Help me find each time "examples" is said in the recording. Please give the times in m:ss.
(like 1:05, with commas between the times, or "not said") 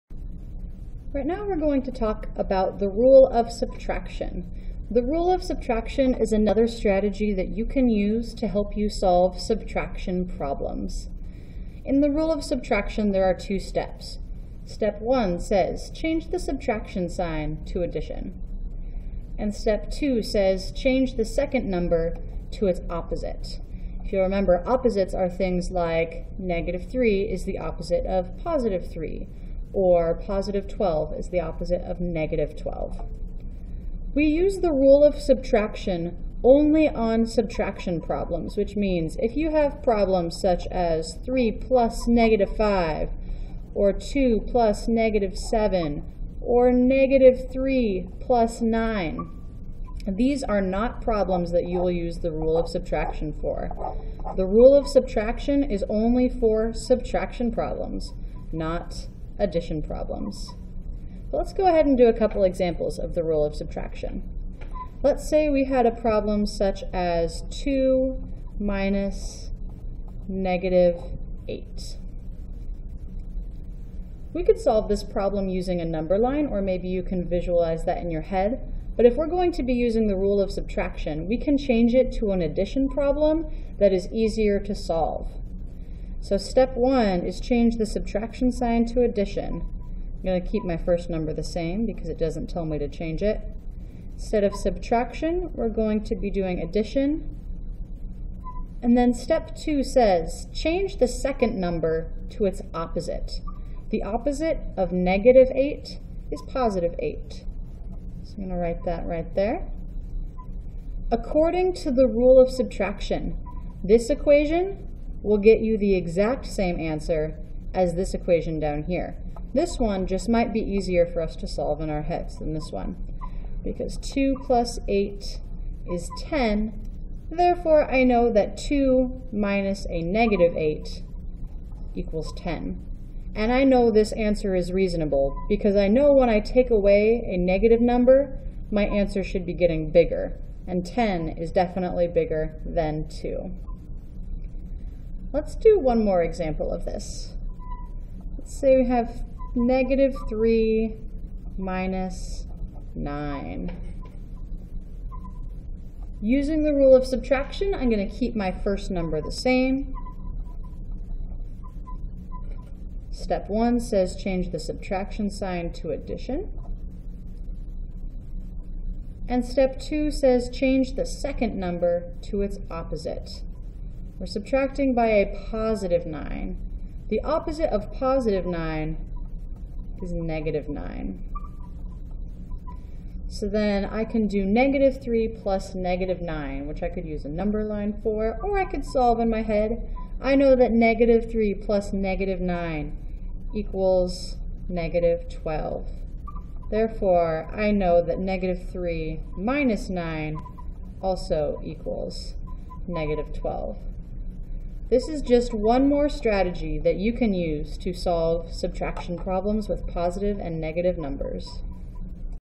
1:02, 2:26.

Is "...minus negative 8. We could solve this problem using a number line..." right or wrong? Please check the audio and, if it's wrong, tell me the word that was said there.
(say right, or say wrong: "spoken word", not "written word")
right.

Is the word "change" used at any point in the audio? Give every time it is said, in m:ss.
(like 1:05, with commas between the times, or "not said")
0:15, 0:20, 1:21, 1:27, 1:32, 1:40, 2:44, 2:50.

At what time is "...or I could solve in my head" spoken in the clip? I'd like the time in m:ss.
3:08.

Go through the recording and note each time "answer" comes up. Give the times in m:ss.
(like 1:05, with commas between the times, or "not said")
1:56, 2:14, 2:18.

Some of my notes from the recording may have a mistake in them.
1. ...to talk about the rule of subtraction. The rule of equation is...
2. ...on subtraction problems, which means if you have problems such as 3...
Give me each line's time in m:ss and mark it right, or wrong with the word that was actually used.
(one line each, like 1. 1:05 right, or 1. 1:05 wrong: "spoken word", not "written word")
1. 0:01 wrong: "subtraction", not "equation"
2. 0:36 right.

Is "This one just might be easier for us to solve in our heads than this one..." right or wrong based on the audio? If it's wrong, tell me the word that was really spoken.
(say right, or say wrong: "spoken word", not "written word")
right.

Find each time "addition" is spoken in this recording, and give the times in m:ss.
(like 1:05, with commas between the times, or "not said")
0:17, 0:59, 1:22, 1:29, 1:36, 2:45.